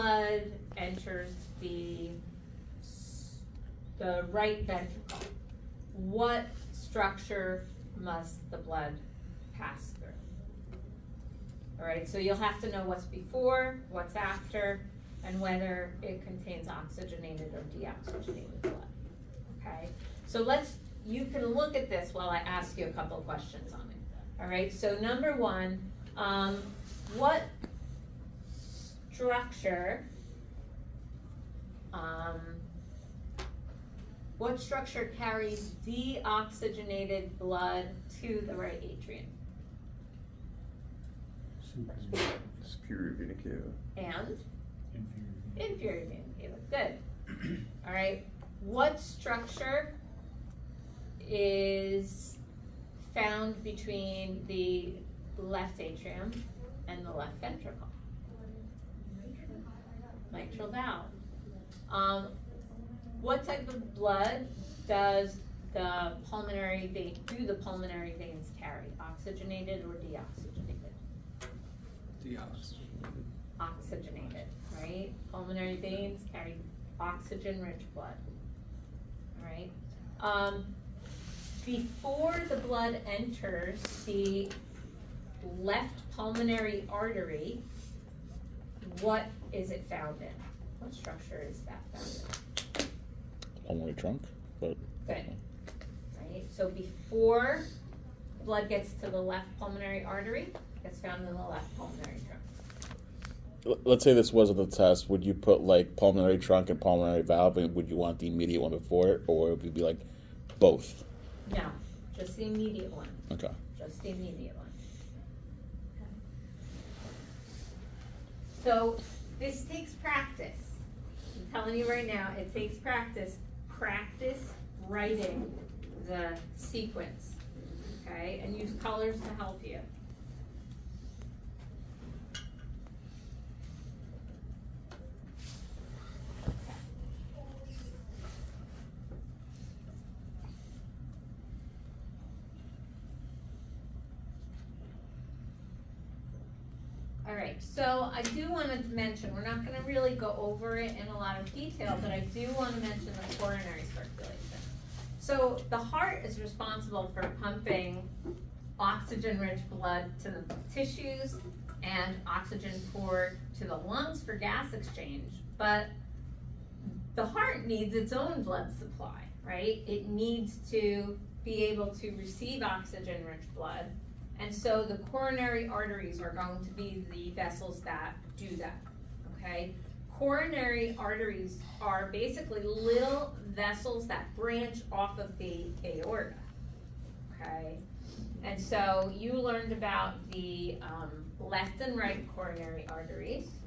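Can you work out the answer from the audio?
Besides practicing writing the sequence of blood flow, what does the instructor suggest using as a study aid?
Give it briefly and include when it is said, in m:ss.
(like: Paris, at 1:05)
Colors, at 2:08.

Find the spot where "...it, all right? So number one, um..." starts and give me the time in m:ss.
0:23.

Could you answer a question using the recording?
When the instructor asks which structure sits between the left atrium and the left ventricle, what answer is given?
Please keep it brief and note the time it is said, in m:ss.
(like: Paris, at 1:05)
Mitral valve, at 1:00.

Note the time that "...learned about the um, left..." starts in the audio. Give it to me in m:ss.
3:09.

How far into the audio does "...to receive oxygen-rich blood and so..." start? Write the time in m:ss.
2:51.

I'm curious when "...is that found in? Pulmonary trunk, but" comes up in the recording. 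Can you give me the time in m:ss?
1:31.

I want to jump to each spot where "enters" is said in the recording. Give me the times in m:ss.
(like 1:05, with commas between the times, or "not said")
0:00, 1:23.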